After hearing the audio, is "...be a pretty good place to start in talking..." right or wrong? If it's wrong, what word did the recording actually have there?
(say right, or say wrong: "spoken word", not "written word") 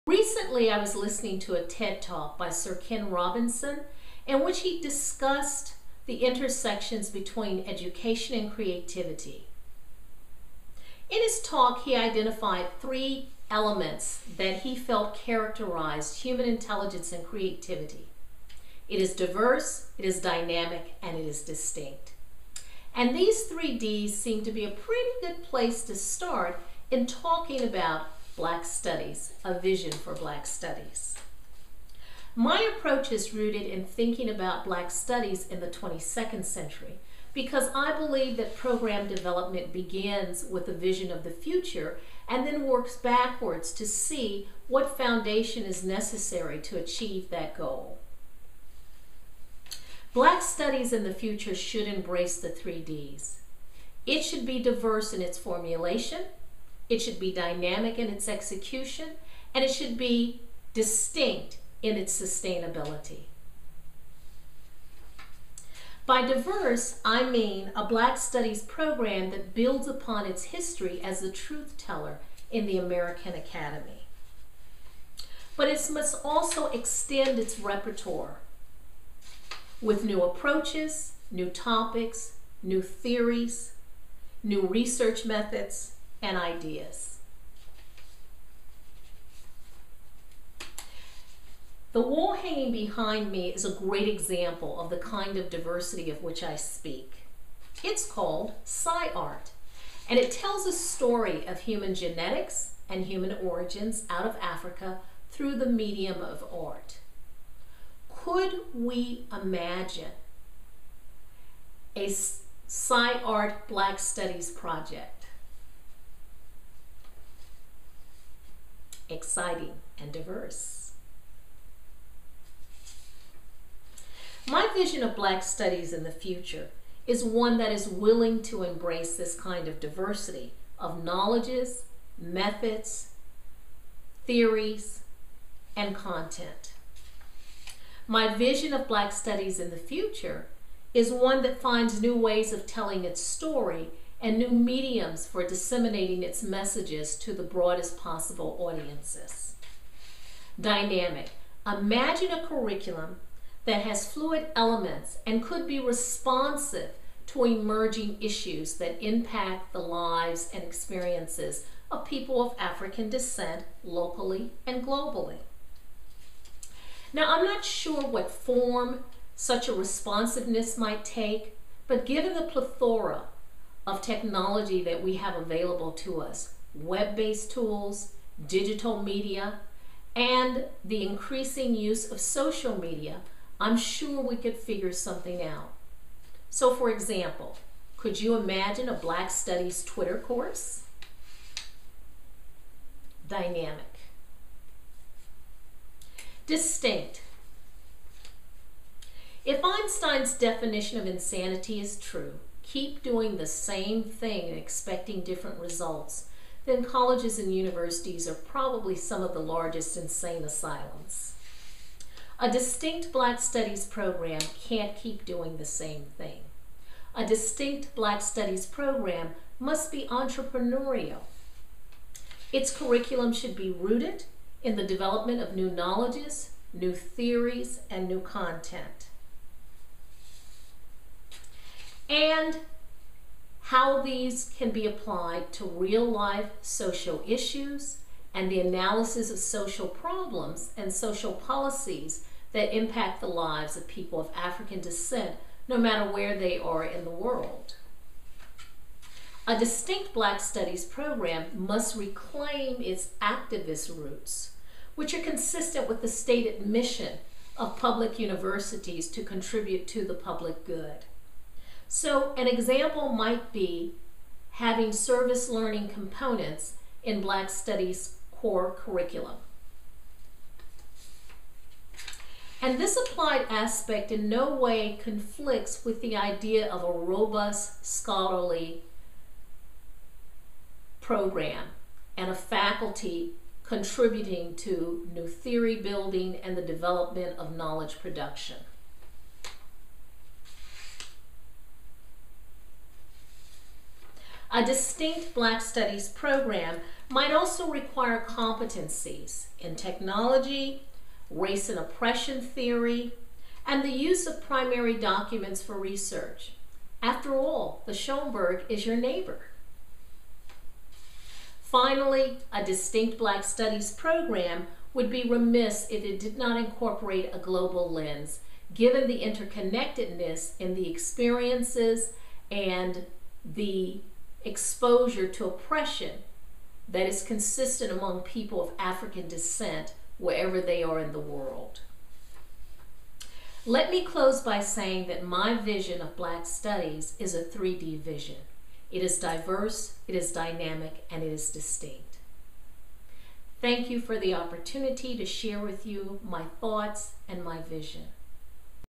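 right.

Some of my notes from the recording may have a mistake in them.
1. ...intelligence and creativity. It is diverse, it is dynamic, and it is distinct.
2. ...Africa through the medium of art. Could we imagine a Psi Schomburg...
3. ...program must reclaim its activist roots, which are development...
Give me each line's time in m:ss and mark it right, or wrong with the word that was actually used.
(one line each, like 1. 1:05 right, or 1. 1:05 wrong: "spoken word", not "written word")
1. 0:16 right
2. 1:44 wrong: "Art", not "Schomburg"
3. 4:10 wrong: "consistent", not "development".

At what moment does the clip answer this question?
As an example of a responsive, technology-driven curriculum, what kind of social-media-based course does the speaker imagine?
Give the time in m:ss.
3:09.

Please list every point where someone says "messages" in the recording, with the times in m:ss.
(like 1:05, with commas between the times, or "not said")
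2:26.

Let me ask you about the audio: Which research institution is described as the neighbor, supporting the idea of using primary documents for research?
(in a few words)
Schomburg.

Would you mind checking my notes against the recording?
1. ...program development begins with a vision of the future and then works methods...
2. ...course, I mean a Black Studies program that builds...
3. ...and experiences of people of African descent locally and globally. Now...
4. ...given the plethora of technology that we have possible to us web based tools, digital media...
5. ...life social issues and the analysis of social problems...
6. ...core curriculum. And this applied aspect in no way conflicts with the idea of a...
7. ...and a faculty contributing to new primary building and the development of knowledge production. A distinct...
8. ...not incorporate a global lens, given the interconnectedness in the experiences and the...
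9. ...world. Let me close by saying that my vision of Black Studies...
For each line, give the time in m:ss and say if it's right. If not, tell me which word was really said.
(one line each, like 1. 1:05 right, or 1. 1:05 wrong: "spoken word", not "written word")
1. 0:38 wrong: "backwards", not "methods"
2. 1:06 wrong: "diverse", not "course"
3. 2:40 right
4. 2:52 wrong: "available", not "possible"
5. 3:56 right
6. 4:28 right
7. 4:42 wrong: "theory", not "primary"
8. 5:16 right
9. 5:31 right.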